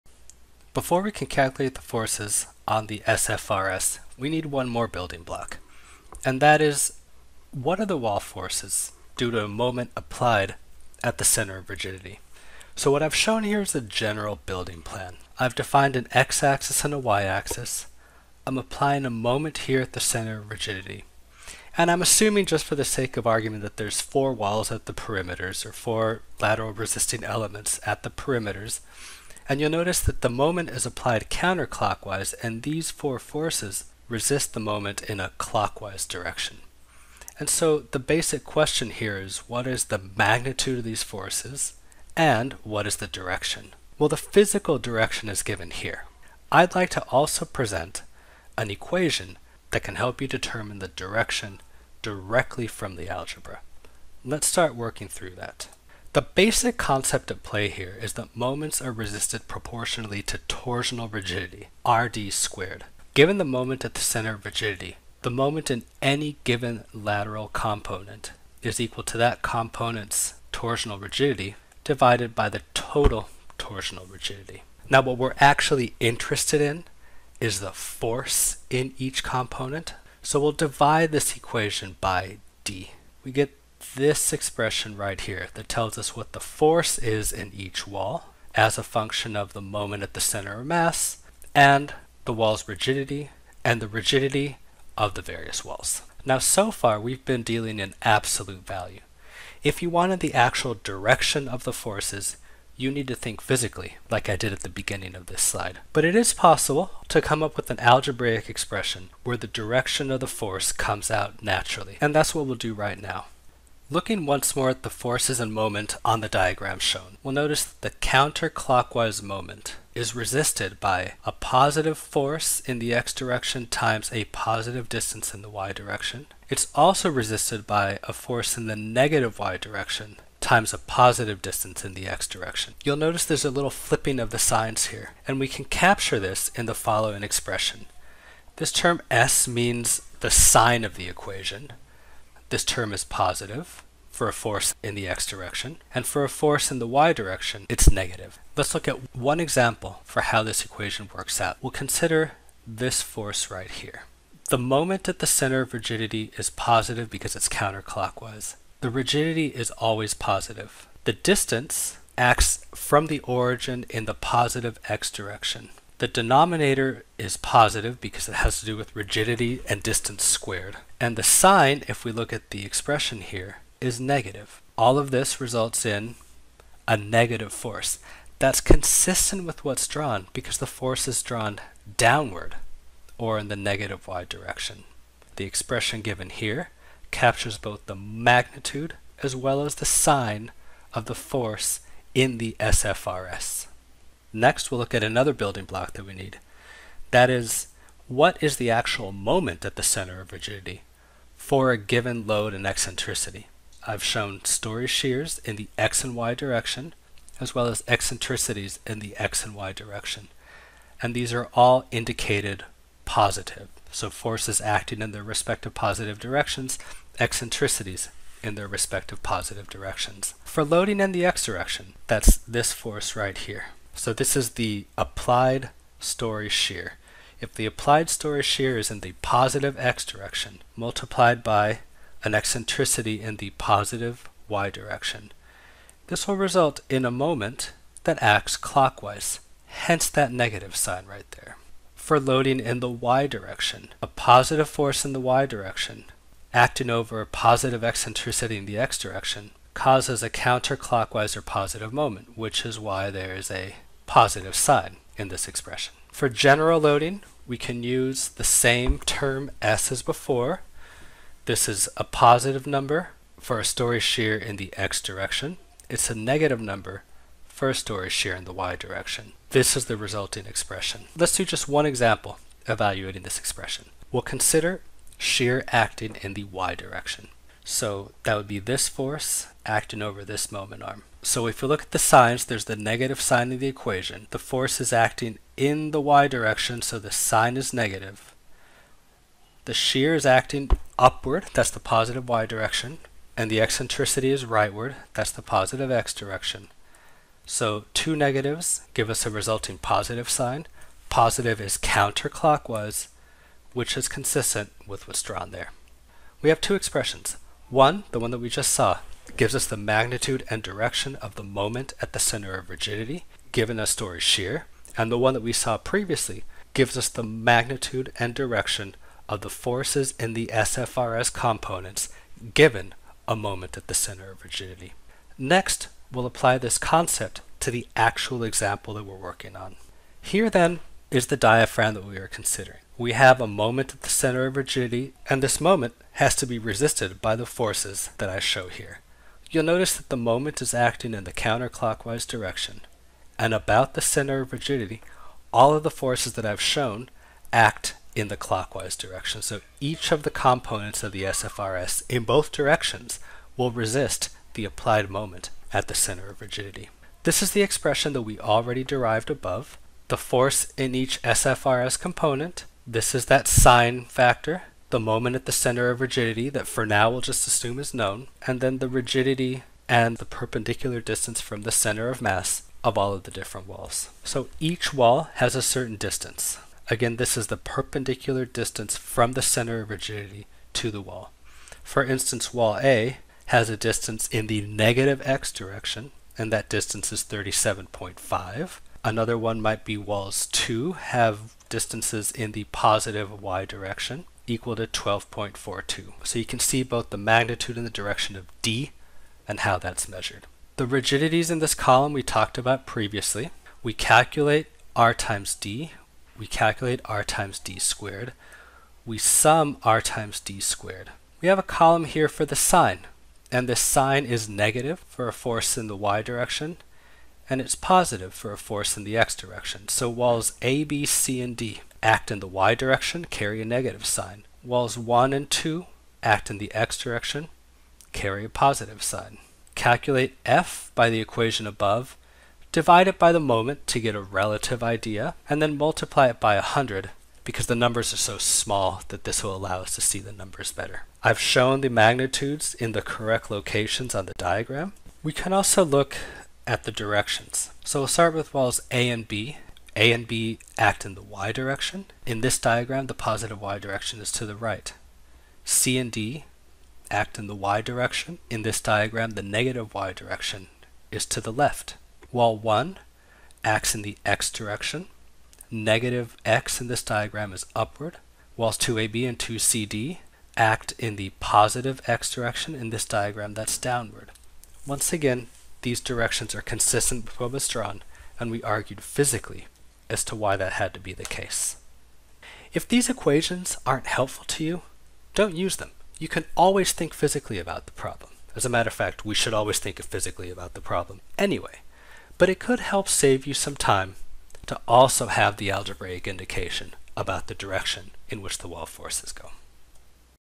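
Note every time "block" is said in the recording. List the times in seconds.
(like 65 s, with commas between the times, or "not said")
5 s, 195 s.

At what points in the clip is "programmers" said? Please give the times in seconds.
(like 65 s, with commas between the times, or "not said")
not said.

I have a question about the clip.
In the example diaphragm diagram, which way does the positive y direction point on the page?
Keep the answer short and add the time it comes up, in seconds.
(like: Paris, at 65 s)
to the right, at 454 s.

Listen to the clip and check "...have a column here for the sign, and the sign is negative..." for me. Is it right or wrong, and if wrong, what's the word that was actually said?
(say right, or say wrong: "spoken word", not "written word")
right.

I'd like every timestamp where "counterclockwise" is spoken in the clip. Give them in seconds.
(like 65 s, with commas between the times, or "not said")
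31 s, 117 s, 157 s, 250 s, 301 s, 341 s.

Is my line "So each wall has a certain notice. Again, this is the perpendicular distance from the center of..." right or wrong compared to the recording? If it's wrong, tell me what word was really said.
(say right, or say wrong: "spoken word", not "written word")
wrong: "distance", not "notice".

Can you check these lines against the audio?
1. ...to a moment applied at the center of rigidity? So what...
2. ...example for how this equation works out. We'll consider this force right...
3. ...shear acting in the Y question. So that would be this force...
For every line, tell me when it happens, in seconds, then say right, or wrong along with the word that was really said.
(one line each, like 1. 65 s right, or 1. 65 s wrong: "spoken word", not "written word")
1. 9 s right
2. 149 s right
3. 275 s wrong: "direction", not "question".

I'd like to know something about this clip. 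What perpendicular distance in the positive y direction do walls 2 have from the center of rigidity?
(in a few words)
12.42.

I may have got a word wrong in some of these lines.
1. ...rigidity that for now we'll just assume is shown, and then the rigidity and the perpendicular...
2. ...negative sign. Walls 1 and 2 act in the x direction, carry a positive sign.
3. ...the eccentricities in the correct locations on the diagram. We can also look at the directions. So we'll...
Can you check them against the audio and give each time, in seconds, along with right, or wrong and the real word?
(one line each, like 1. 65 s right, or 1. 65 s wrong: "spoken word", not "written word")
1. 366 s wrong: "known", not "shown"
2. 423 s right
3. 441 s wrong: "magnitudes", not "eccentricities".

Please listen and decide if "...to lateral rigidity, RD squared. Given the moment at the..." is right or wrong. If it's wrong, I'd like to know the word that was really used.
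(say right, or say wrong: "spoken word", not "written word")
wrong: "torsional", not "lateral".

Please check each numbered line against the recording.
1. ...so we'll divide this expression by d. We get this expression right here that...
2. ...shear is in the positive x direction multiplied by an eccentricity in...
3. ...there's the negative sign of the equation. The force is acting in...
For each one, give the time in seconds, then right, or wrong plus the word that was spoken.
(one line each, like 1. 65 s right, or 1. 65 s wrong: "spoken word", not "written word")
1. 80 s wrong: "equation", not "expression"
2. 228 s right
3. 282 s right.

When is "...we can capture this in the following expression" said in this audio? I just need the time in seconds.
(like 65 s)
135 s.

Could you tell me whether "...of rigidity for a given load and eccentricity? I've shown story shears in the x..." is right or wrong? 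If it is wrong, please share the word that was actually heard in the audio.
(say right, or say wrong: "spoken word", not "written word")
right.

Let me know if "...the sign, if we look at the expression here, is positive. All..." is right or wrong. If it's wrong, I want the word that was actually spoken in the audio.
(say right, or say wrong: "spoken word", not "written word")
wrong: "negative", not "positive".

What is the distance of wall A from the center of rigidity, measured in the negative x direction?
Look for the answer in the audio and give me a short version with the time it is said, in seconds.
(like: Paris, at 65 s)
37.5, at 387 s.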